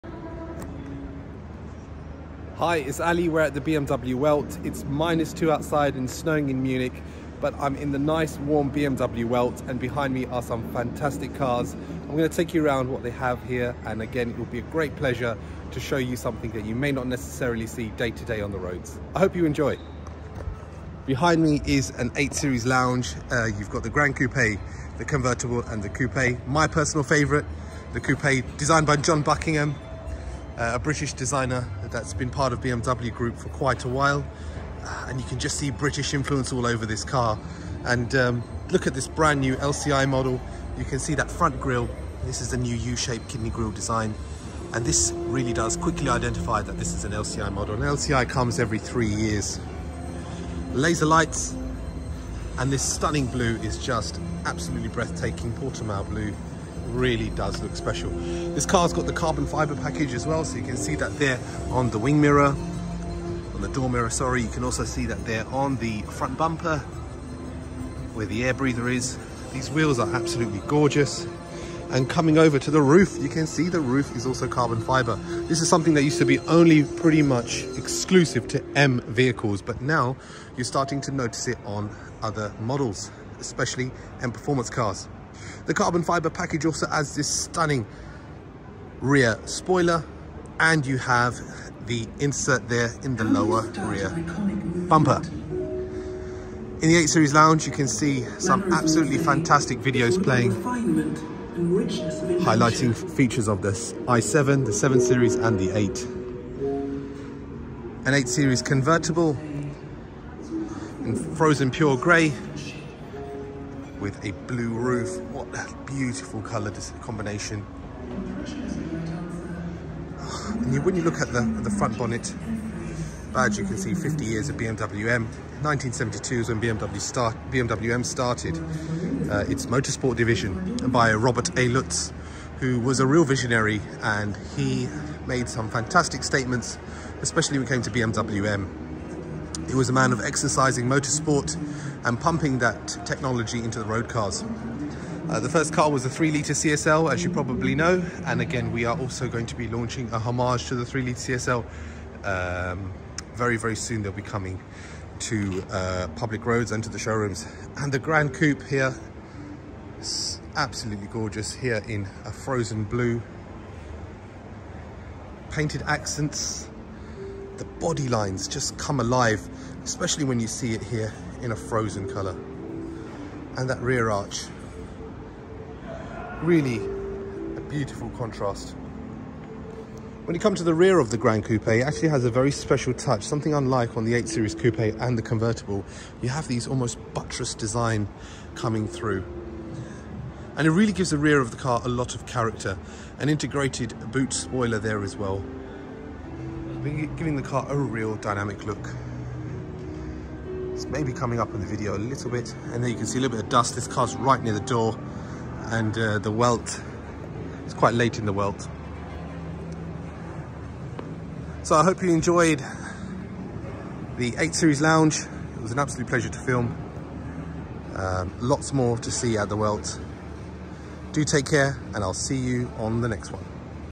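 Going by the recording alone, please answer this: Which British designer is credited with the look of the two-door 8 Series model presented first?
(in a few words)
John Buckingham.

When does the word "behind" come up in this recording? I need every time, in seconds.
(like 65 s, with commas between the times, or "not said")
9 s, 21 s.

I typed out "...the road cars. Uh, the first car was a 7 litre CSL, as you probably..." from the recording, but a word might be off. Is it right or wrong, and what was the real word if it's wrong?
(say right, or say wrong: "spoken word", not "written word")
wrong: "3", not "7".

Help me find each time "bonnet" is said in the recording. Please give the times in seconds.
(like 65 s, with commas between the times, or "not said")
121 s.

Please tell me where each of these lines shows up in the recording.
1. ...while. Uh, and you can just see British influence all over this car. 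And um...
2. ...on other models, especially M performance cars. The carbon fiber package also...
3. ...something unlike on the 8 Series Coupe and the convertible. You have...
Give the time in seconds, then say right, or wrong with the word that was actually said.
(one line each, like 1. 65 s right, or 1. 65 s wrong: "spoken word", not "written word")
1. 33 s right
2. 81 s right
3. 183 s right.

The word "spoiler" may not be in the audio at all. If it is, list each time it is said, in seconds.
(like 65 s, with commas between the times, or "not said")
89 s, 194 s.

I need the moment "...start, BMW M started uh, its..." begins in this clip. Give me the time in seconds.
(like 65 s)
126 s.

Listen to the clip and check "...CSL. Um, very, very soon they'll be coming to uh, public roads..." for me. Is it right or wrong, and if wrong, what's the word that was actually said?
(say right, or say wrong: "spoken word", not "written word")
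right.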